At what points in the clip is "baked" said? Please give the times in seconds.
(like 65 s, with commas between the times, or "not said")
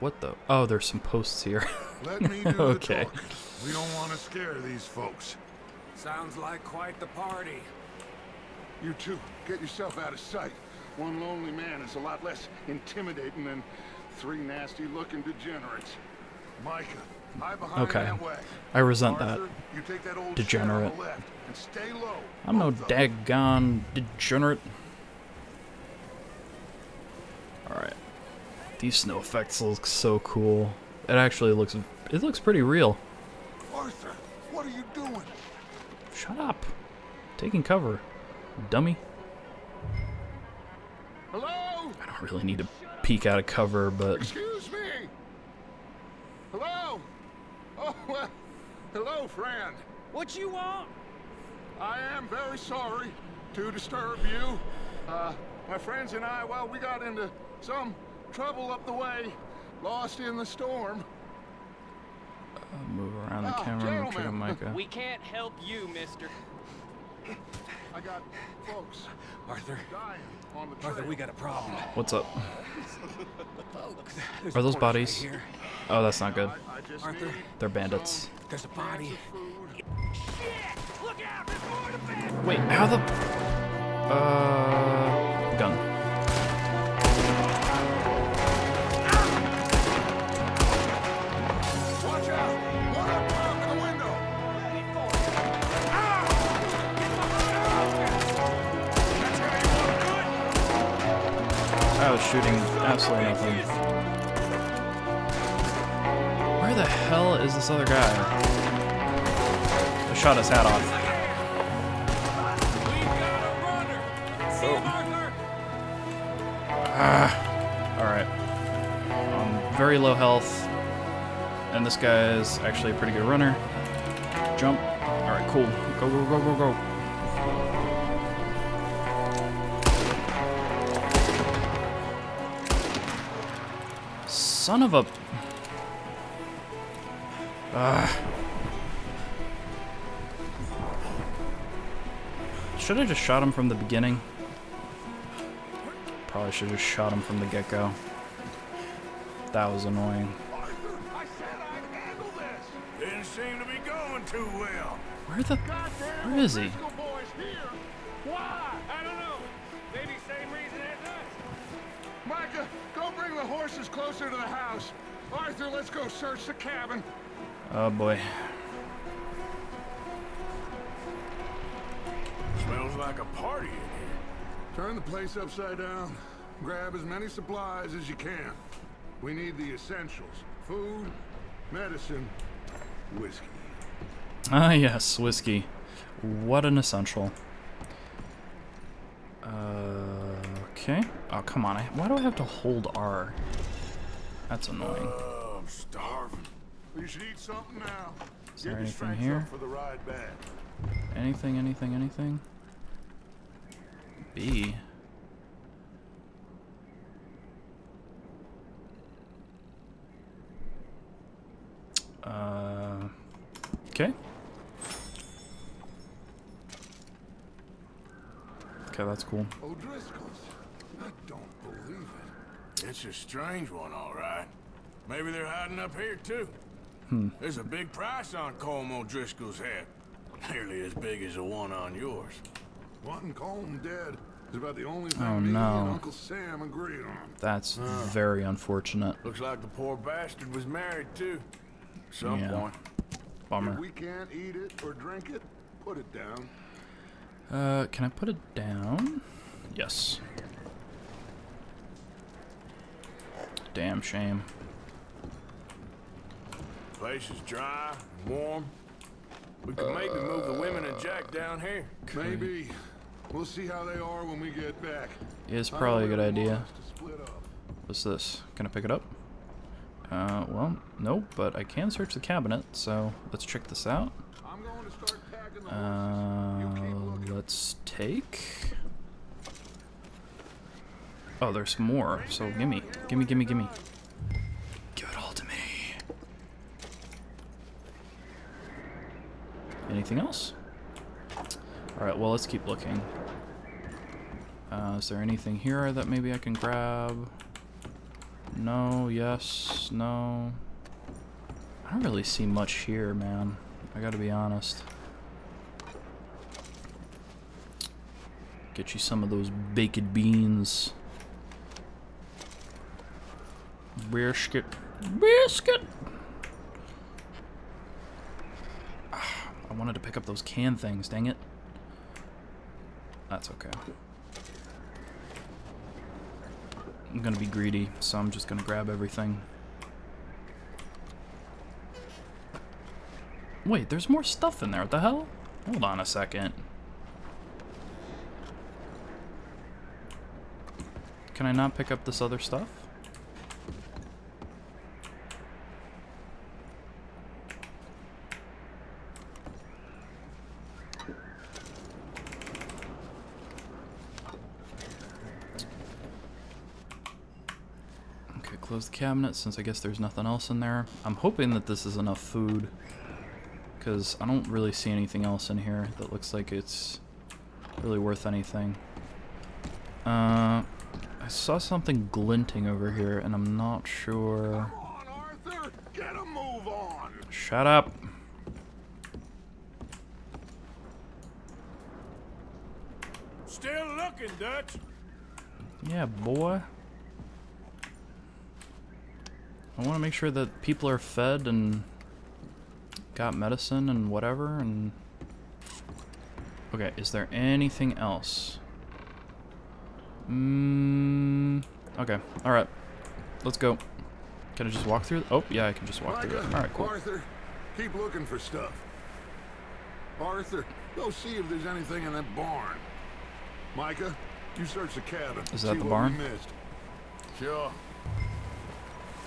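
309 s.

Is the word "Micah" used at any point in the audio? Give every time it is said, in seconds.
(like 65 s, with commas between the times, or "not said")
16 s, 64 s, 413 s.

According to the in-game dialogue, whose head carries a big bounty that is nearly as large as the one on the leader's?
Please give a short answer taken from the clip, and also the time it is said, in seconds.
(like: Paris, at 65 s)
Colm O'Driscoll, at 228 s.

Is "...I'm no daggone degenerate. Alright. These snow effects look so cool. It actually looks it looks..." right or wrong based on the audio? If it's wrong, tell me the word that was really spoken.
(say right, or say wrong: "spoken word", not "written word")
right.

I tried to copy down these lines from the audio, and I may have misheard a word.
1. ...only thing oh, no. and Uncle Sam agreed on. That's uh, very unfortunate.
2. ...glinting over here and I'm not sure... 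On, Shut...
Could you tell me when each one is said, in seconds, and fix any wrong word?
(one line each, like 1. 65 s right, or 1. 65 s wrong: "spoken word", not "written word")
1. 234 s right
2. 372 s right.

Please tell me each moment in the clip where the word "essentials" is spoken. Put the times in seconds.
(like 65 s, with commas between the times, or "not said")
179 s, 186 s.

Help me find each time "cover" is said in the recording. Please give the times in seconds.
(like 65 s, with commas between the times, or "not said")
37 s, 43 s.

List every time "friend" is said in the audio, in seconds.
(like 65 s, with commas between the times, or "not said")
49 s, 55 s.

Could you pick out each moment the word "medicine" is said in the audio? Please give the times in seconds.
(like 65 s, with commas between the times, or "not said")
181 s, 393 s.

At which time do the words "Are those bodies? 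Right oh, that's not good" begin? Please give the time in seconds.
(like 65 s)
74 s.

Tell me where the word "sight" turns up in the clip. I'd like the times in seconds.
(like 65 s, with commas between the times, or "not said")
10 s.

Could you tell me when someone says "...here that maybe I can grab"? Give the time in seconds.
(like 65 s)
295 s.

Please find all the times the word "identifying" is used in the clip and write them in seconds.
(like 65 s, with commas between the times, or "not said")
not said.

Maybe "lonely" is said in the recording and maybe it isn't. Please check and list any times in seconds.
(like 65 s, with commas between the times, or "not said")
11 s.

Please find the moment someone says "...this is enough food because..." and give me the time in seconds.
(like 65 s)
361 s.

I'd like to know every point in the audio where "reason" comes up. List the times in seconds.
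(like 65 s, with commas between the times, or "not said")
160 s.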